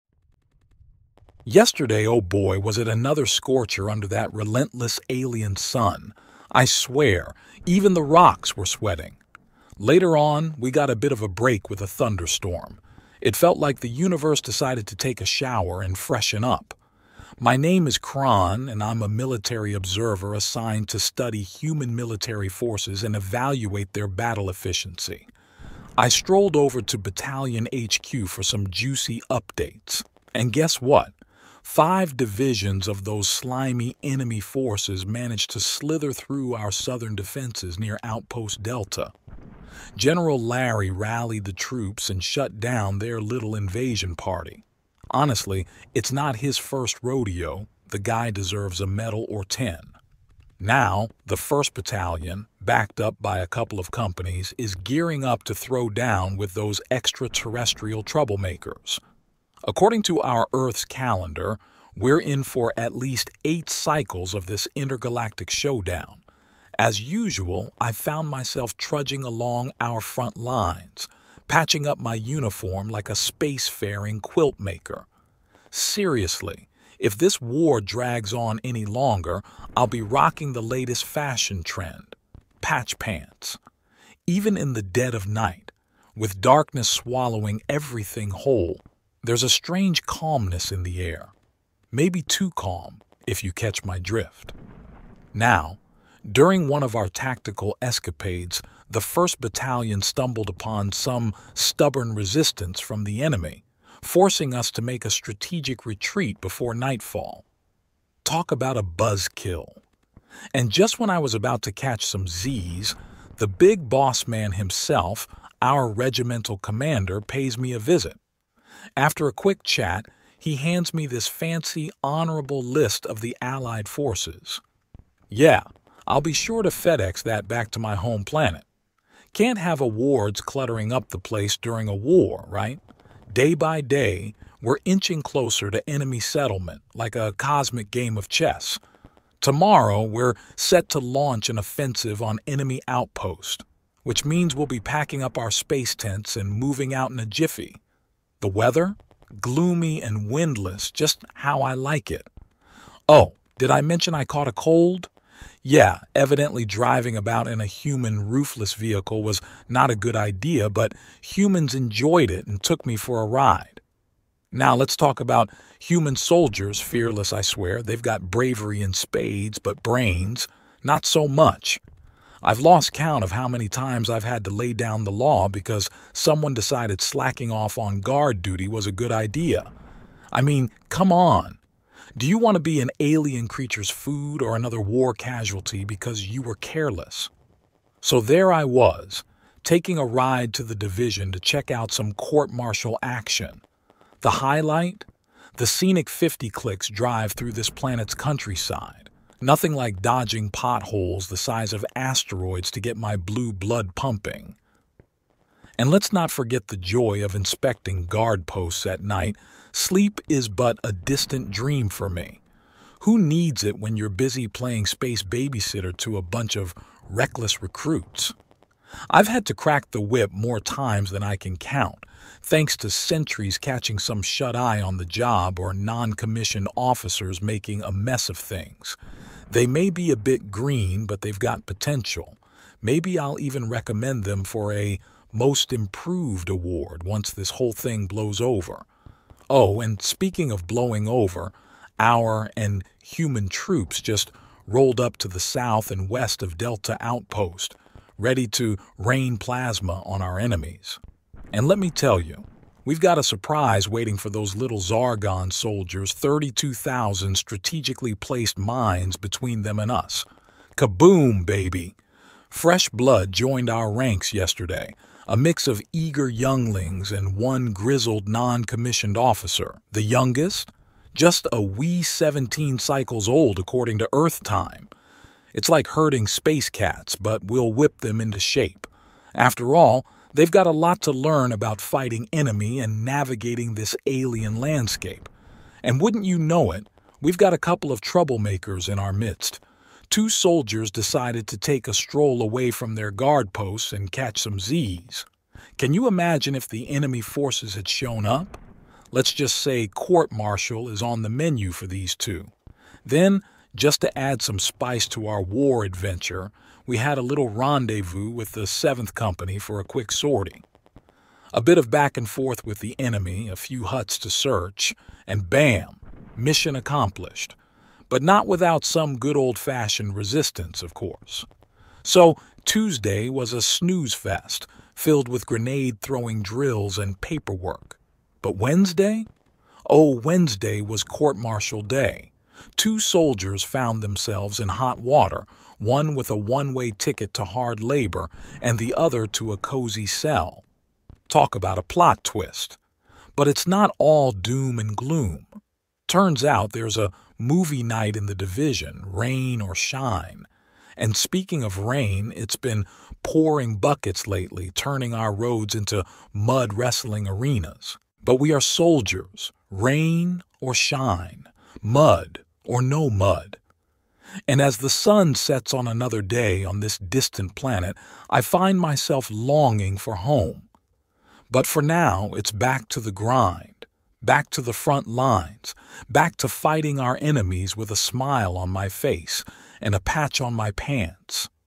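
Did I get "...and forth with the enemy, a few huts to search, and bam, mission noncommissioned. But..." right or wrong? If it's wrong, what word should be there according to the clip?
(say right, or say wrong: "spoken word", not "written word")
wrong: "accomplished", not "noncommissioned".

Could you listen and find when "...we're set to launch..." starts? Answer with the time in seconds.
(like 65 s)
140 s.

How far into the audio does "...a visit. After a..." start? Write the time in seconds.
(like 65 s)
117 s.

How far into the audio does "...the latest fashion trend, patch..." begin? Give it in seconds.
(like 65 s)
80 s.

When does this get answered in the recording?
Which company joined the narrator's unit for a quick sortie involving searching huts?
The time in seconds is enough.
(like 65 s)
308 s.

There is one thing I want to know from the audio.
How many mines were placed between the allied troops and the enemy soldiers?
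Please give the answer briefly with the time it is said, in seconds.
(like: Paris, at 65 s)
32,000, at 256 s.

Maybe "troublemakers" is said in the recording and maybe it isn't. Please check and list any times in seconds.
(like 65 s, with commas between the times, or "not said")
58 s, 287 s.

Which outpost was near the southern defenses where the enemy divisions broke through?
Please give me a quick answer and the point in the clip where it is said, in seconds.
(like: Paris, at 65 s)
Outpost Delta, at 38 s.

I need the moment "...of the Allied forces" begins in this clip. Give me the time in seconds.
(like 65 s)
123 s.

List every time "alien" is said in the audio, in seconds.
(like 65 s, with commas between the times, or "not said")
5 s, 182 s, 284 s.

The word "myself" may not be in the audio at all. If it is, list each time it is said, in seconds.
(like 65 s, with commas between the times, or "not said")
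68 s, 368 s.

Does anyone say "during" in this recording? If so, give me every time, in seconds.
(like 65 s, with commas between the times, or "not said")
96 s, 131 s.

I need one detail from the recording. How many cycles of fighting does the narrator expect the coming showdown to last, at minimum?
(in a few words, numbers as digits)
8.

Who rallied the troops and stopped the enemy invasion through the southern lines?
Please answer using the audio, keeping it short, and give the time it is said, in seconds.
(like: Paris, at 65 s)
General Larry, at 39 s.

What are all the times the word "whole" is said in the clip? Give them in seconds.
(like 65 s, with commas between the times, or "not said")
88 s, 237 s.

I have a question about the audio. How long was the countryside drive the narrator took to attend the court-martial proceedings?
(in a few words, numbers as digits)
50 clicks.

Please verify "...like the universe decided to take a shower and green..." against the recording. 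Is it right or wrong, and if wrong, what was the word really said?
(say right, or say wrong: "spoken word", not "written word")
wrong: "freshen", not "green".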